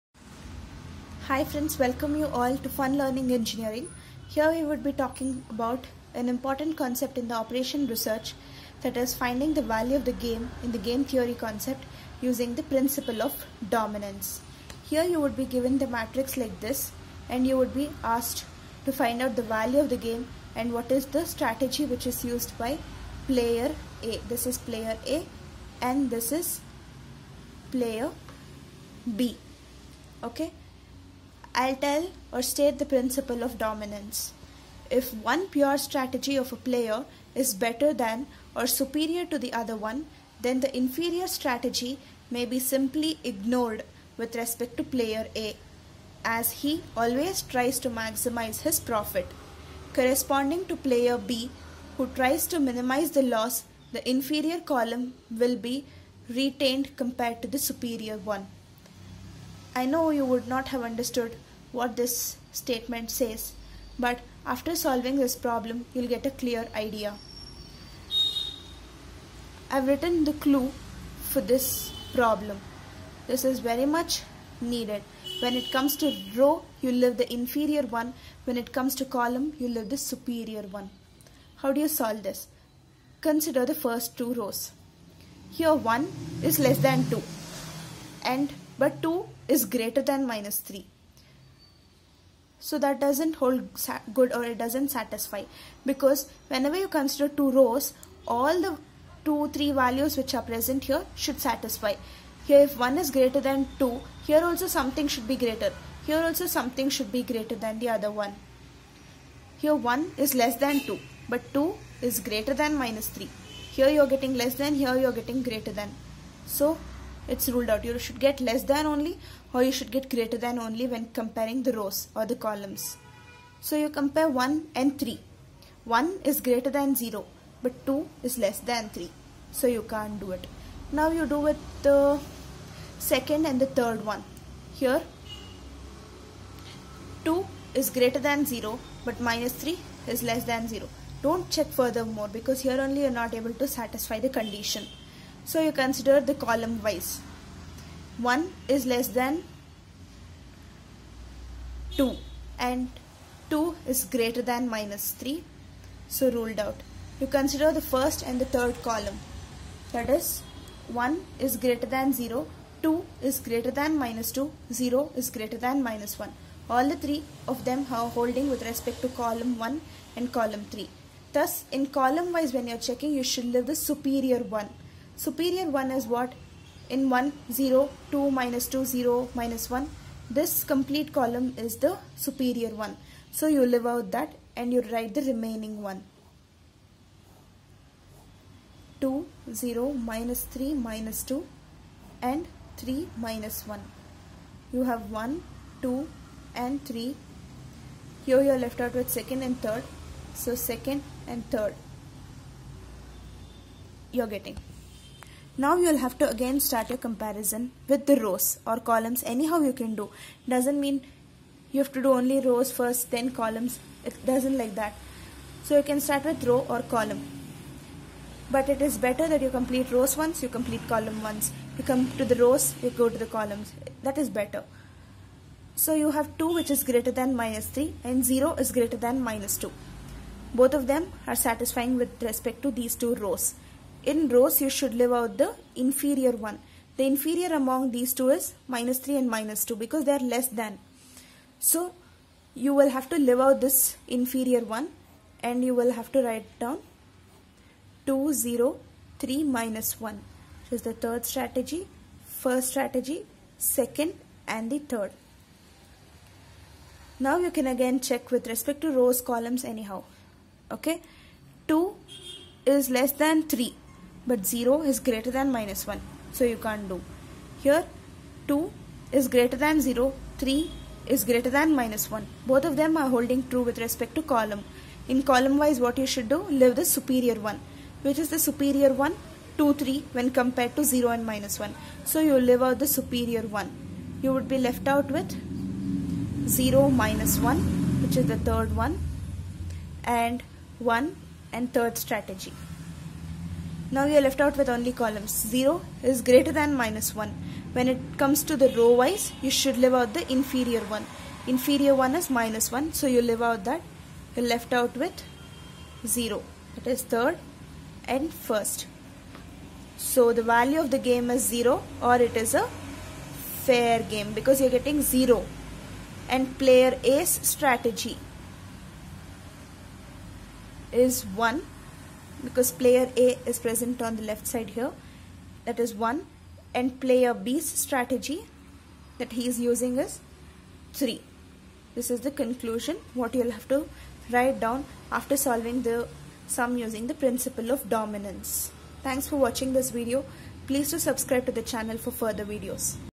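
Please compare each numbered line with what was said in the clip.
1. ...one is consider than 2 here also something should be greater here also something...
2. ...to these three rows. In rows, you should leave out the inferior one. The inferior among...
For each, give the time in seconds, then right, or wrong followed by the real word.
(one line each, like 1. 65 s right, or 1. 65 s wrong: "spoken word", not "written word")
1. 102 s wrong: "greater", not "consider"
2. 232 s wrong: "two", not "three".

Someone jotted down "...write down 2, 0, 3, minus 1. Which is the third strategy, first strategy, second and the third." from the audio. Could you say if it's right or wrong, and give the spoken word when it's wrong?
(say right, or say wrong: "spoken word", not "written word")
right.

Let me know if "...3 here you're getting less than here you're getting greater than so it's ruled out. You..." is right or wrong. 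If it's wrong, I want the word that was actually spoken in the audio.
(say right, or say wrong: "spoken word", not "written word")
right.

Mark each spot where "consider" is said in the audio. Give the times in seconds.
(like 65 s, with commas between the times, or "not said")
83 s, 96 s, 145 s, 157 s.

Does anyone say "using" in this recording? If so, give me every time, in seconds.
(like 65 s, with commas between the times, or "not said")
12 s, 329 s, 336 s.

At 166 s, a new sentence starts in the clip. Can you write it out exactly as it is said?
All the three of them are holding with respect to column 1 and column 3.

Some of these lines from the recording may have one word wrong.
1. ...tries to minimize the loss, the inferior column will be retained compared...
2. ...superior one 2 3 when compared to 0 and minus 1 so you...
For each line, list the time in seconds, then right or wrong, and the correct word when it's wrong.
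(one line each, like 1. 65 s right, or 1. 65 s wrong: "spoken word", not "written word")
1. 52 s right
2. 278 s right.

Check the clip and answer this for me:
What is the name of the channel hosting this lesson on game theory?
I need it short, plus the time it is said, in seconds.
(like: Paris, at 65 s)
Fun Learning Engineering, at 2 s.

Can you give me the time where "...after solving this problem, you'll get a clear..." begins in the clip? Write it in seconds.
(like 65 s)
64 s.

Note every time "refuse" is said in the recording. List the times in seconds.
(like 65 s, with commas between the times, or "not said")
not said.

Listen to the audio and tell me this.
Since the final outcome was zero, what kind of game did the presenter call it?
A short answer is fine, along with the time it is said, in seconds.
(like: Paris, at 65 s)
fair game, at 313 s.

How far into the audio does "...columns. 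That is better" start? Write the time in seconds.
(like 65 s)
223 s.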